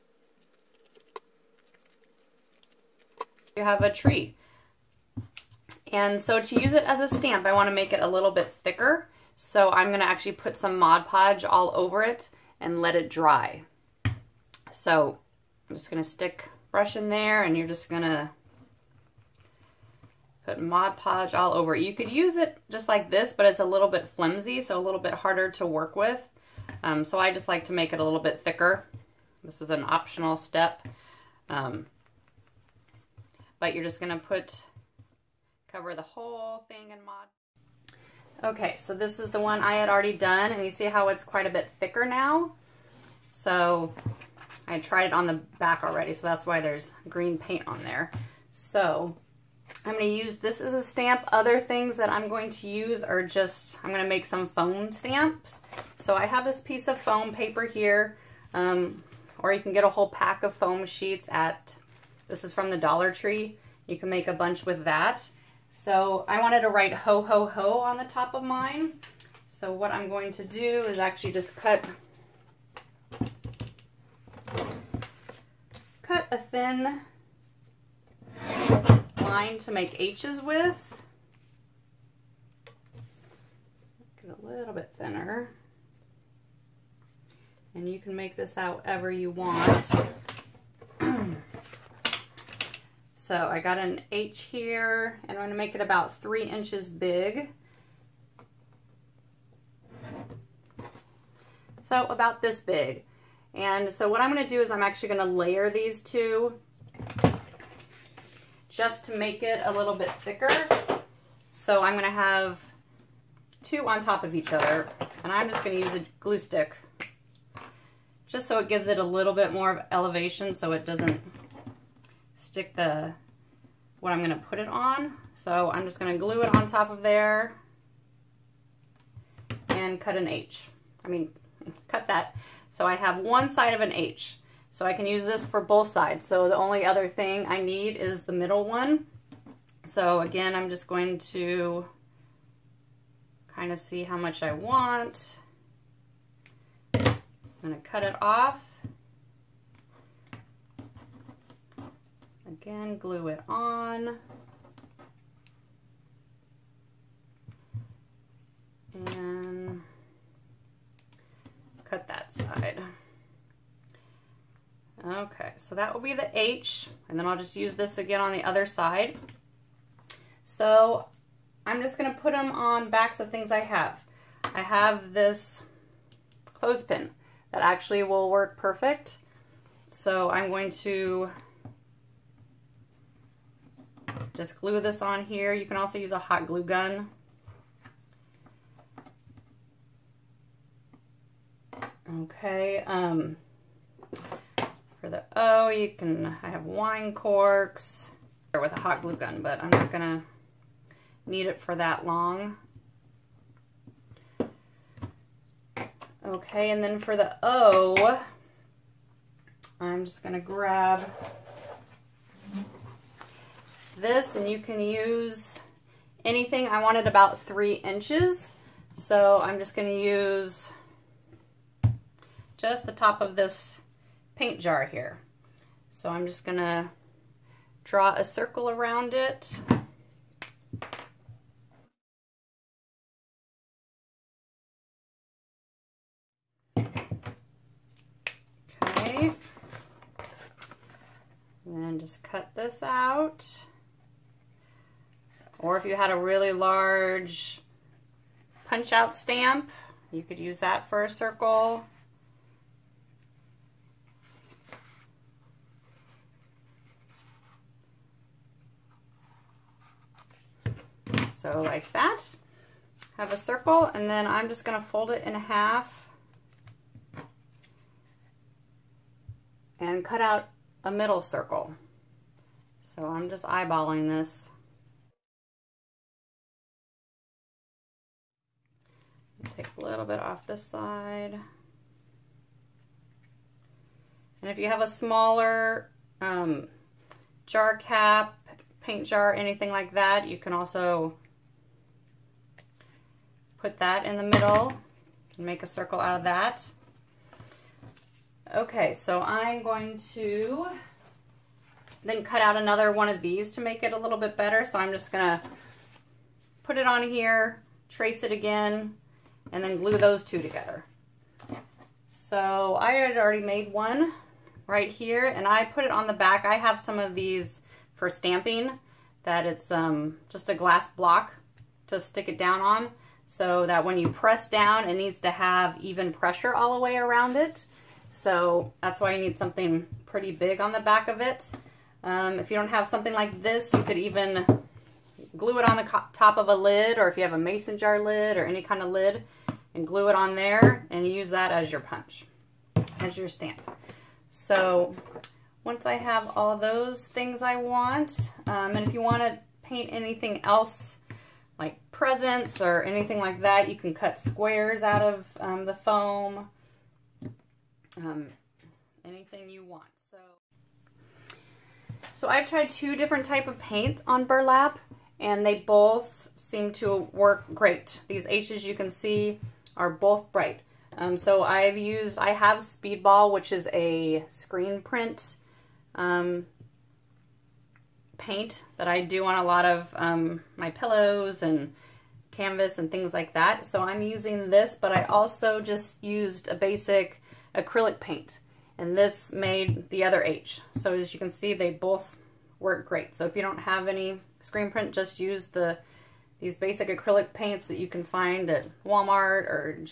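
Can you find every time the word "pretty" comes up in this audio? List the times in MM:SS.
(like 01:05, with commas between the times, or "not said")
05:30.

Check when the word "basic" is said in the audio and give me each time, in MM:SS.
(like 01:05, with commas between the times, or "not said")
06:26, 06:36.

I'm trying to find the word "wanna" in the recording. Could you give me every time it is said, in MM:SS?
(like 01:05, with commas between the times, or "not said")
00:07.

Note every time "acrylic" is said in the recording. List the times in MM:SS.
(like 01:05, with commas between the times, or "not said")
06:27, 06:36.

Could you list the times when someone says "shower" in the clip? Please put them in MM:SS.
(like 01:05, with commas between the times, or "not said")
not said.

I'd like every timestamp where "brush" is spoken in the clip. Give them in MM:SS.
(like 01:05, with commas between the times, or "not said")
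00:16.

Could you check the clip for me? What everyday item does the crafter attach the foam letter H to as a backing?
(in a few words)
clothespin.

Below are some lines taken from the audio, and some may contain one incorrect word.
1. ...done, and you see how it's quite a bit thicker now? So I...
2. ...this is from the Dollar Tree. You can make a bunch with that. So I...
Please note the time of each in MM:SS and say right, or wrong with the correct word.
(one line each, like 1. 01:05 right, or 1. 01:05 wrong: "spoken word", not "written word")
1. 00:40 right
2. 01:02 right.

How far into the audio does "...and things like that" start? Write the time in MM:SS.
06:22.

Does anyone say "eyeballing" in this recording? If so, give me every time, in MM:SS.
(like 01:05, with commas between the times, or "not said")
04:33.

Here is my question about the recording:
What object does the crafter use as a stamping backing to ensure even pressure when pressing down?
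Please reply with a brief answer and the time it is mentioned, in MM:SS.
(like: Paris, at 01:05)
glass block, at 05:20.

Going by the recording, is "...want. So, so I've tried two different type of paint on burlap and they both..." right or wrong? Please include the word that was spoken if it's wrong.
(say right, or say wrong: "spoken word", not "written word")
right.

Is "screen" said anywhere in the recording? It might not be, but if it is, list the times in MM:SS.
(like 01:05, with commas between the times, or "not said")
06:14, 06:34.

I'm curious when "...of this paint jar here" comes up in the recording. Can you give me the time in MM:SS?
03:43.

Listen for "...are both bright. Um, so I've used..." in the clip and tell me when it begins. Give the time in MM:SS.
06:09.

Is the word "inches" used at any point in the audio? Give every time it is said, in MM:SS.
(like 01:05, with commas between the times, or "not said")
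01:36, 03:37.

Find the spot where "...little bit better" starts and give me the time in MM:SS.
05:03.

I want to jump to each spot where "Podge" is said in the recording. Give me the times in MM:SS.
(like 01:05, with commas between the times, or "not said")
00:11, 00:20.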